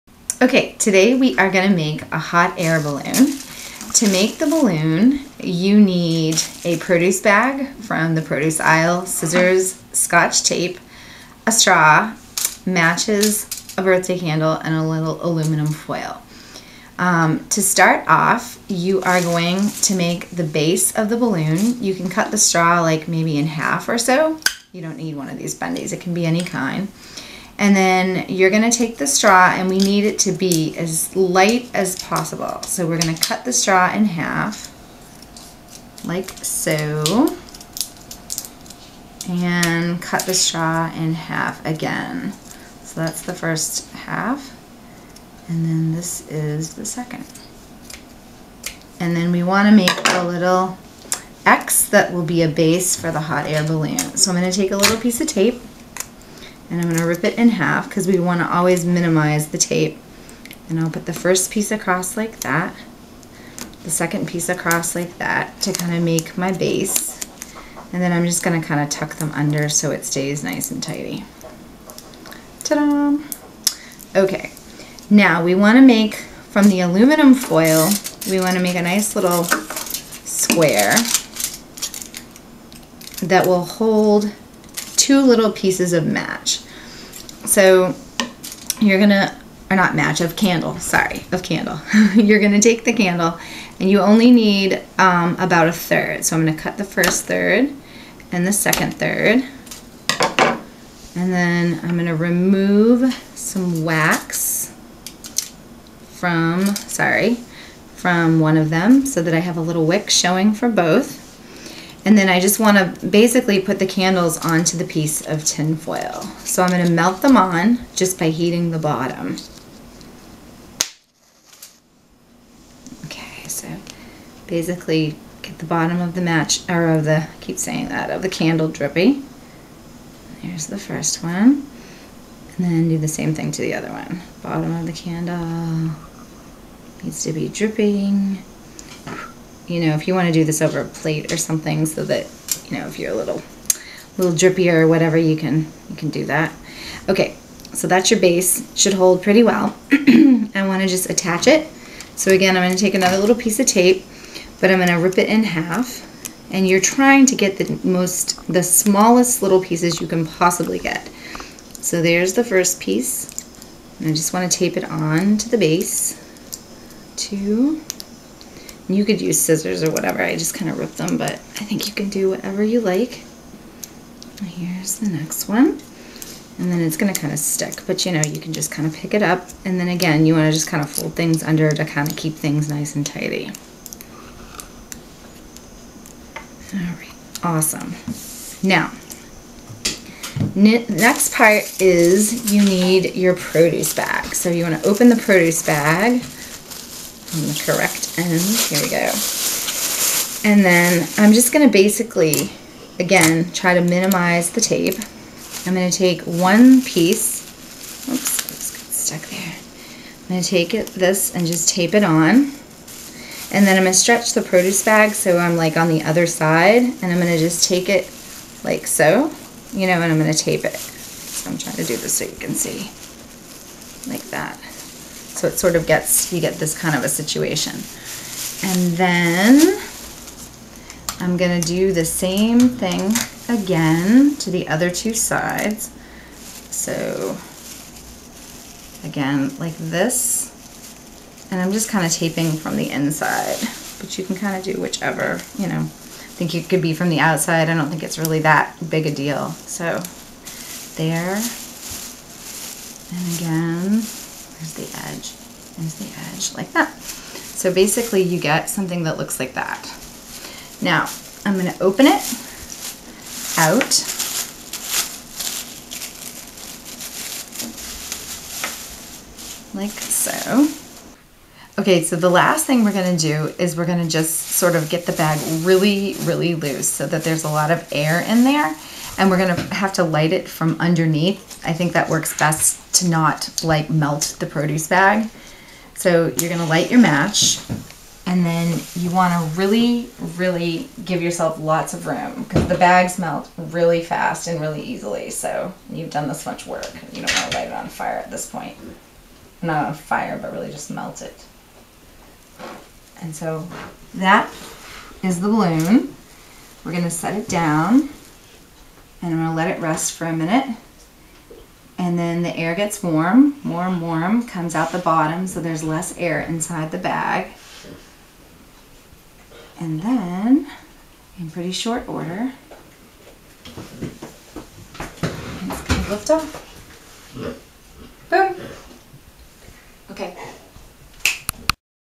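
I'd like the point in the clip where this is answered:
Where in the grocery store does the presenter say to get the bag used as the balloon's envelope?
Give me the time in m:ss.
0:08.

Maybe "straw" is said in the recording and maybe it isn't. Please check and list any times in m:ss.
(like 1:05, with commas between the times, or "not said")
0:11, 0:22, 0:29, 0:33, 0:40.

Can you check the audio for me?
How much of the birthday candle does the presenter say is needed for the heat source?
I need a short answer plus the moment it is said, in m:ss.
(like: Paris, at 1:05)
about a third, at 1:35.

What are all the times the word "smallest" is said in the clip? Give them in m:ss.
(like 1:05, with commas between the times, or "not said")
2:38.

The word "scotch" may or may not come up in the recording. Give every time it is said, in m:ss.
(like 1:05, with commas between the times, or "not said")
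0:09.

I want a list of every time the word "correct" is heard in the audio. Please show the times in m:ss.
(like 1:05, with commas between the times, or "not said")
3:17.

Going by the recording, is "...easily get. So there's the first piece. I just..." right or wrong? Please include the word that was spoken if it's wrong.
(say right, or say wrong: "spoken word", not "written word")
wrong: "possibly", not "easily".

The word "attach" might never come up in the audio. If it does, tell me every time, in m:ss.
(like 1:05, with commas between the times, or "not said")
2:31.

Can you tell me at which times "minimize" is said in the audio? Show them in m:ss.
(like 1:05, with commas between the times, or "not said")
0:58, 3:23.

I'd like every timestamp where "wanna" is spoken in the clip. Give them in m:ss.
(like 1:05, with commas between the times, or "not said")
4:49, 4:57.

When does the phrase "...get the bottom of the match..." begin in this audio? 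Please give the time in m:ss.
2:05.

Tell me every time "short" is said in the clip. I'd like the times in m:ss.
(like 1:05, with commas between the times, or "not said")
5:21.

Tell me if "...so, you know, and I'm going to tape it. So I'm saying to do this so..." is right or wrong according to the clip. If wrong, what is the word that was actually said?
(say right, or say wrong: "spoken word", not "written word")
wrong: "trying", not "saying".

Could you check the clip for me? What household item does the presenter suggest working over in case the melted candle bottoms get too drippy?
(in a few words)
a plate.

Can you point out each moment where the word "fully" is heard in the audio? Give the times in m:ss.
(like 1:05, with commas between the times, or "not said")
not said.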